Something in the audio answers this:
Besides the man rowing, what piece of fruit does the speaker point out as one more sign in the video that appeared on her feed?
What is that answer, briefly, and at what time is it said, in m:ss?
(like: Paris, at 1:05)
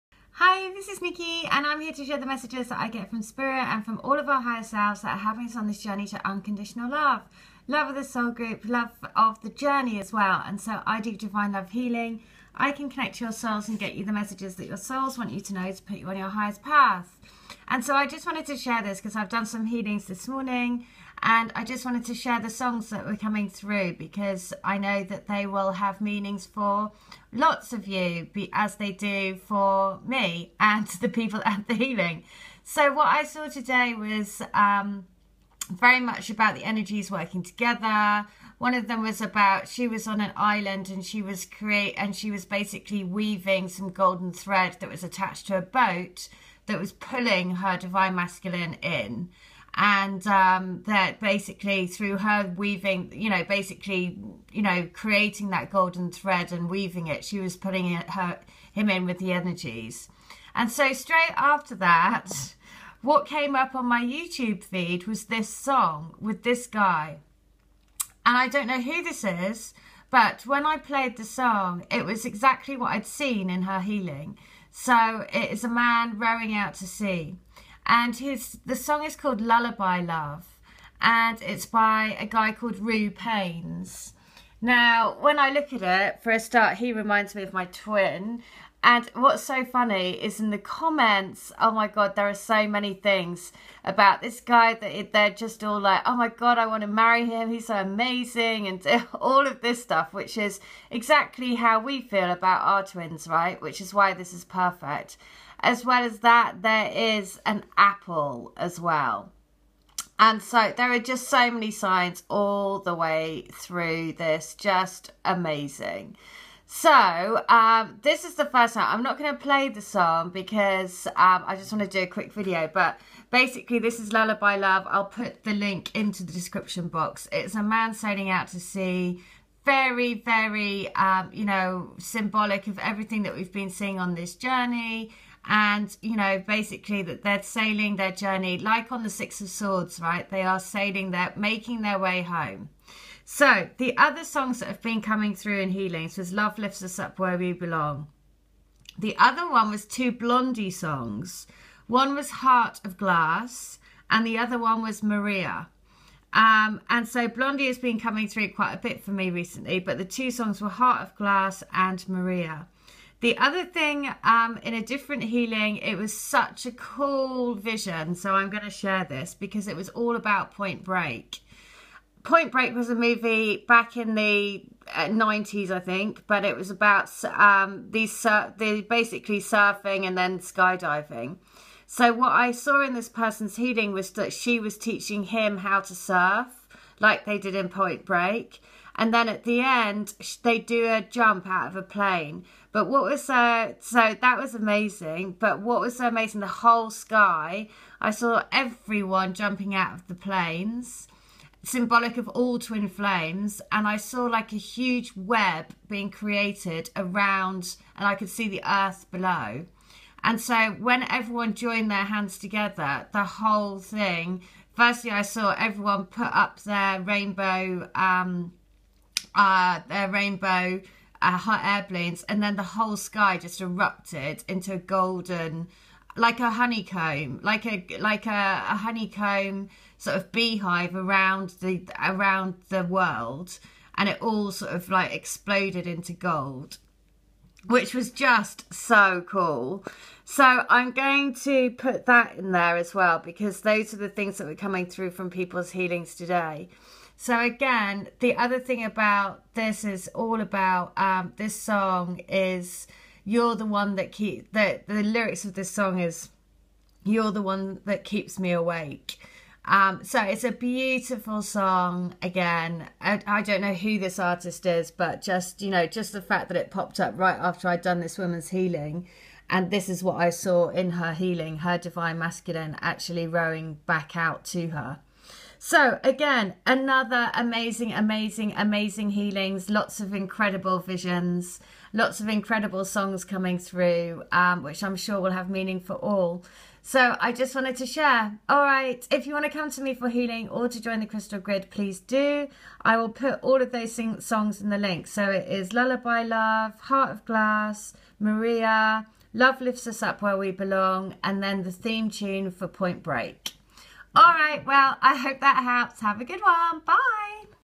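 apple, at 1:47.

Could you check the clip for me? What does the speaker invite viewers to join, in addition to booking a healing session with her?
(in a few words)
the Crystal Grid.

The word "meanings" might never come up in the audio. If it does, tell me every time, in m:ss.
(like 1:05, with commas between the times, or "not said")
0:26, 4:45.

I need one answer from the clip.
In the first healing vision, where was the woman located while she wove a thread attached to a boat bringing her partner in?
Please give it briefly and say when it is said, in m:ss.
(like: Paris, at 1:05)
an island, at 0:40.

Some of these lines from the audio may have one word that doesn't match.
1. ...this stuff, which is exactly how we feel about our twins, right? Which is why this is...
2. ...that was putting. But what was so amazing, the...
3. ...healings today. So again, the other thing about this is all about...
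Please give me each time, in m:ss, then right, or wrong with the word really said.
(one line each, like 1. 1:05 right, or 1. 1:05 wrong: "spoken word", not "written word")
1. 1:39 right
2. 3:14 wrong: "amazing", not "putting"
3. 4:05 right.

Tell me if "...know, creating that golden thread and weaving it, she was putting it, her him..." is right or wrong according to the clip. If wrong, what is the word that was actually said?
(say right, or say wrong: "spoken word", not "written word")
right.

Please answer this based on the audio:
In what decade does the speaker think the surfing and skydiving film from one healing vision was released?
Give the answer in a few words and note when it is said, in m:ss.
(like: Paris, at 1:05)
the 90s, at 2:54.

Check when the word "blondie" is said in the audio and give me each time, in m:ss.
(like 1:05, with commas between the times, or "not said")
2:30, 2:37.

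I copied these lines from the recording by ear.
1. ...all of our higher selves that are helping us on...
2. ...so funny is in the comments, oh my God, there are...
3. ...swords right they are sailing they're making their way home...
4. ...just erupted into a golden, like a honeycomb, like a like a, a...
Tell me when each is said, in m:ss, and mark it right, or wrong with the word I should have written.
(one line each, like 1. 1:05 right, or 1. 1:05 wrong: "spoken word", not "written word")
1. 0:04 right
2. 1:29 right
3. 2:19 right
4. 3:43 right.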